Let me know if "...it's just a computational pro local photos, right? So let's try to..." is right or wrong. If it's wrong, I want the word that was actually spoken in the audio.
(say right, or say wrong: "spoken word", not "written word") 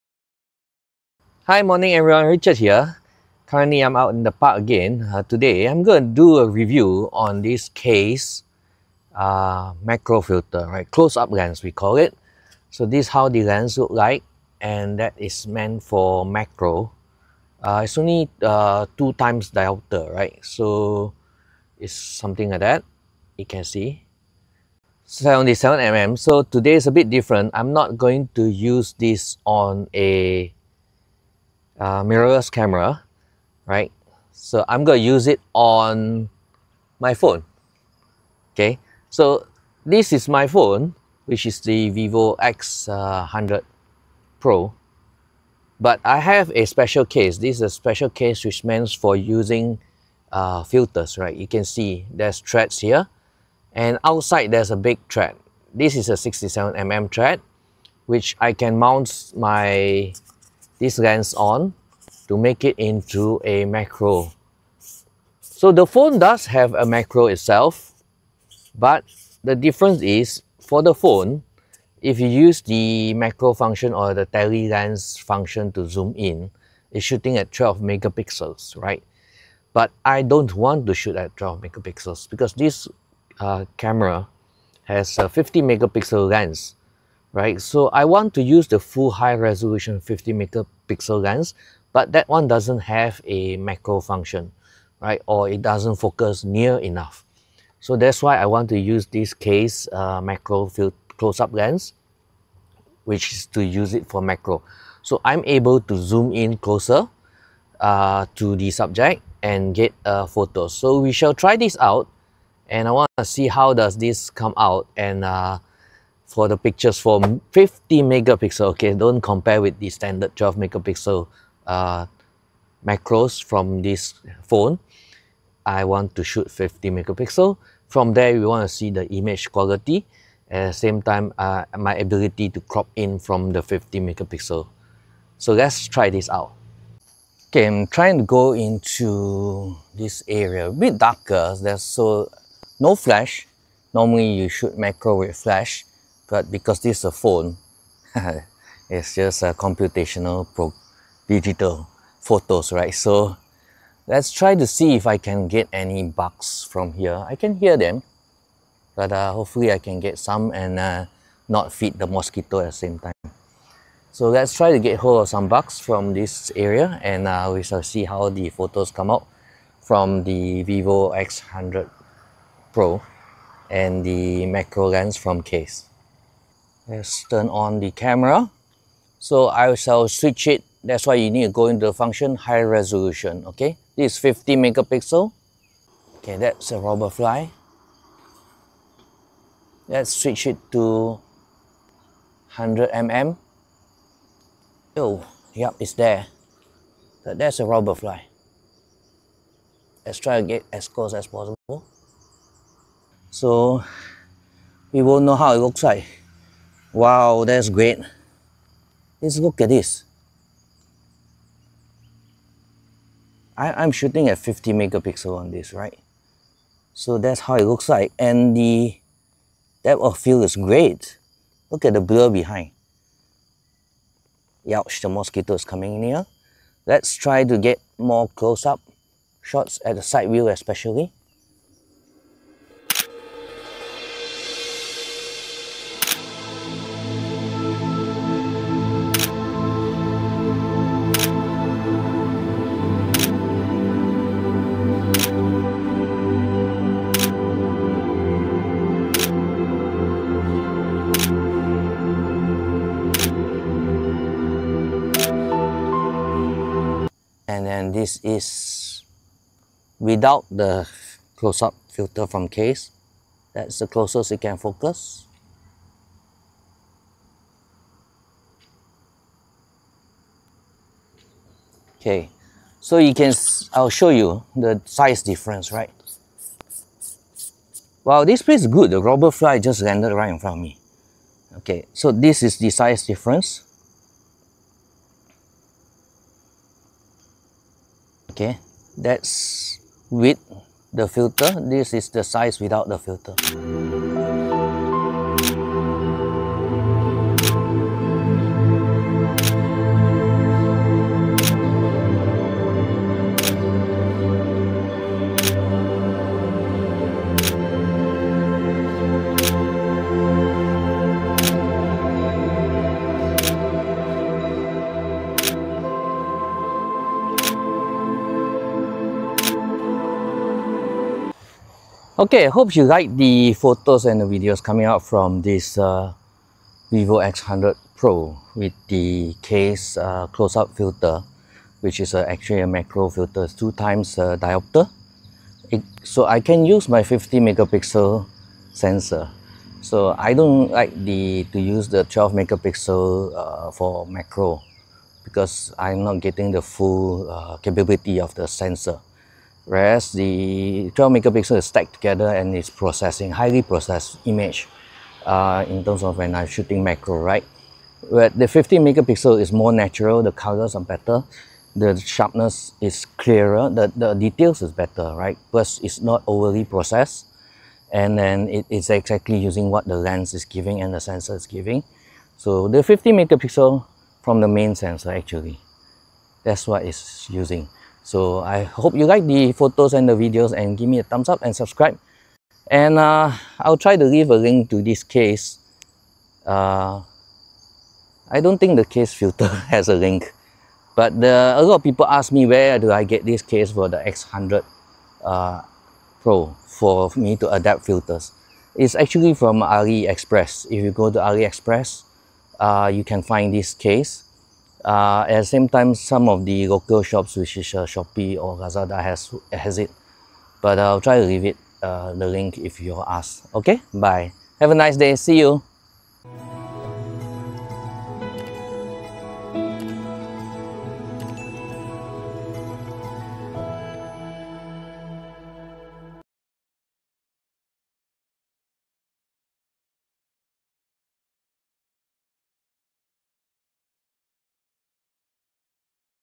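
wrong: "digital", not "local".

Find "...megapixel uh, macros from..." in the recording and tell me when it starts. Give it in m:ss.
2:00.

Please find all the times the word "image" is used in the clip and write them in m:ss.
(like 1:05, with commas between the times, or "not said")
2:09, 5:54.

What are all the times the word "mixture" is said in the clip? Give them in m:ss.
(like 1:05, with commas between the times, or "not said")
not said.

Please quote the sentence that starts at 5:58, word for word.
But the 15 megapixel is more natural, the colors are better, the sharpness is clearer, the, the details is better, right?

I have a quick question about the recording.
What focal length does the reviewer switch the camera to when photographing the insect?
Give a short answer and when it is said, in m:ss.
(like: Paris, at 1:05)
100 mm, at 3:12.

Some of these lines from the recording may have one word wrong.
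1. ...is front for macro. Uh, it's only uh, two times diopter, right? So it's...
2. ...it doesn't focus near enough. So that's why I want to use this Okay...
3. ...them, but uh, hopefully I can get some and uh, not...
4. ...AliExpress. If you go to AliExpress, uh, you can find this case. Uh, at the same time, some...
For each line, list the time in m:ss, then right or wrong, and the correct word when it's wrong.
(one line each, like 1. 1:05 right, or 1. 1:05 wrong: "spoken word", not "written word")
1. 0:15 wrong: "meant", not "front"
2. 1:35 wrong: "Kase", not "Okay"
3. 2:37 right
4. 6:39 right.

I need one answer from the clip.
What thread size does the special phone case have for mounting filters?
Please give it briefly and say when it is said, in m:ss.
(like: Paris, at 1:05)
67mm, at 0:56.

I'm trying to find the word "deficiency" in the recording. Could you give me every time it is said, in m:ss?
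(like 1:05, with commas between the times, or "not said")
not said.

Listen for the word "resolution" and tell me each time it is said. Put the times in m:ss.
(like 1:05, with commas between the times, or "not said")
1:29, 3:02.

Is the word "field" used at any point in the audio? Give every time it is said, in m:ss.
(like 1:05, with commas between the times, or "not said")
1:40, 3:40.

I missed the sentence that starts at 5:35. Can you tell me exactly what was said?
It, so I can use my 50 megapixel sensor.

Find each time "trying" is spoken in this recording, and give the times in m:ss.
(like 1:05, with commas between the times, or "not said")
2:17.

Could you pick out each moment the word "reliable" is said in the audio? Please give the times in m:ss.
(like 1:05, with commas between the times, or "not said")
not said.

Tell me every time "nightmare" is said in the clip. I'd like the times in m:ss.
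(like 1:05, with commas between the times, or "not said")
not said.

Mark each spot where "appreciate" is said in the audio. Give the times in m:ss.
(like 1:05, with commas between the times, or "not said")
not said.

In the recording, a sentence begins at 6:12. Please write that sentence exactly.
So the 15 megapixel from the main sensor actually, that's what it's using.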